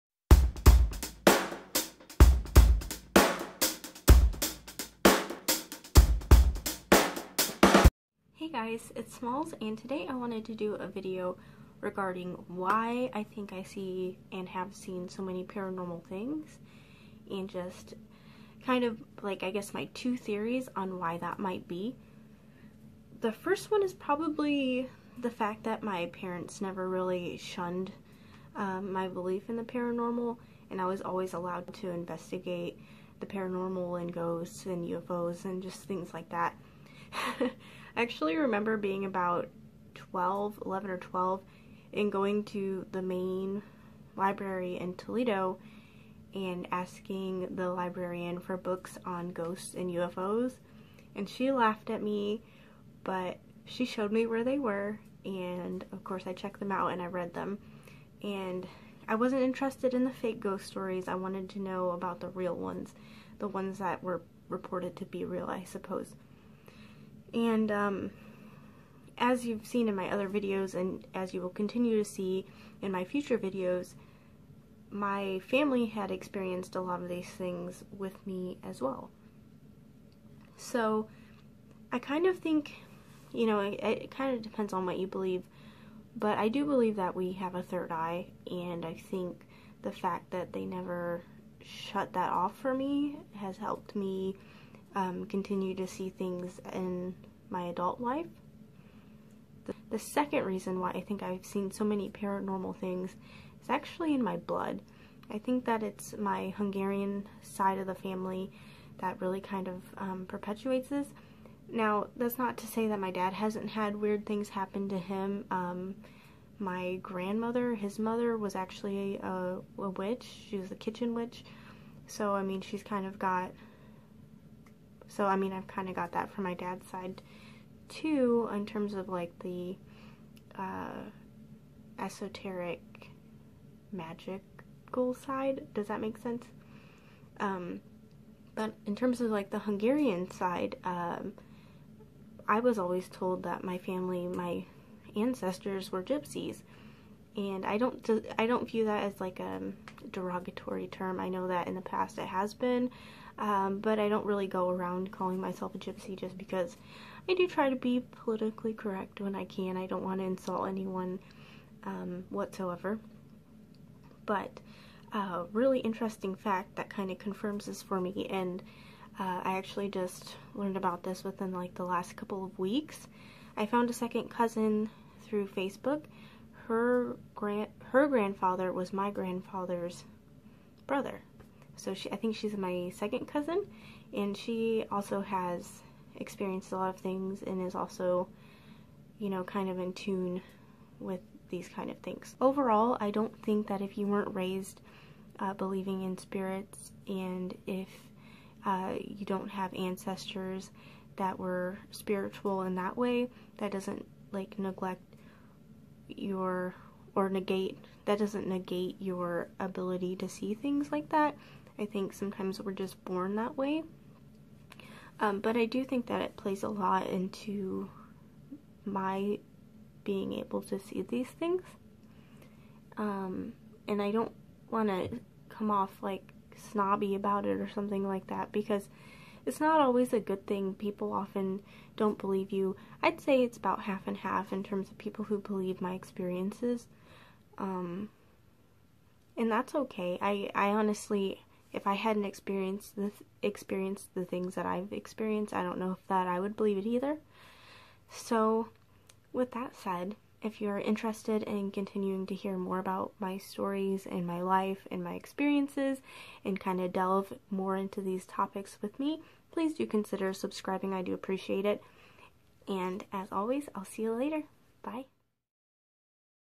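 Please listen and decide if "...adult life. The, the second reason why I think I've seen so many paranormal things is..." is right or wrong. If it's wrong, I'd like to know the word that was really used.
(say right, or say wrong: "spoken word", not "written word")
right.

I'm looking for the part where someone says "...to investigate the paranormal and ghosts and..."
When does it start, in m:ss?
0:31.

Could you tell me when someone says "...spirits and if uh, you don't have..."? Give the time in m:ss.
3:16.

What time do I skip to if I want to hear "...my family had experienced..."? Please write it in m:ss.
1:14.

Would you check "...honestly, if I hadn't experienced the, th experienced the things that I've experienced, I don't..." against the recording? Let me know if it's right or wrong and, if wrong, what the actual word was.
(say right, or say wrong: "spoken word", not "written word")
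right.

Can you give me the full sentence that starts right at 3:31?
I think sometimes we're just born that way.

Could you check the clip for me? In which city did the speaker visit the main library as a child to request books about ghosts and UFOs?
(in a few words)
Toledo.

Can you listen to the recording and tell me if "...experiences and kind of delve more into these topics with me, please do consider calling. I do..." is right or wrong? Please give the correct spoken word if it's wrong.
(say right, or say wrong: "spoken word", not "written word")
wrong: "subscribing", not "calling".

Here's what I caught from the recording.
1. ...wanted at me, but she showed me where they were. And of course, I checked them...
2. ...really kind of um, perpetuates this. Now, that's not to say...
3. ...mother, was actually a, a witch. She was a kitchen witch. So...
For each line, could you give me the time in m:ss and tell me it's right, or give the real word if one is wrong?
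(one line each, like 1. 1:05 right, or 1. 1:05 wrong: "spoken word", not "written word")
1. 0:51 wrong: "laughed", not "wanted"
2. 1:49 right
3. 1:57 right.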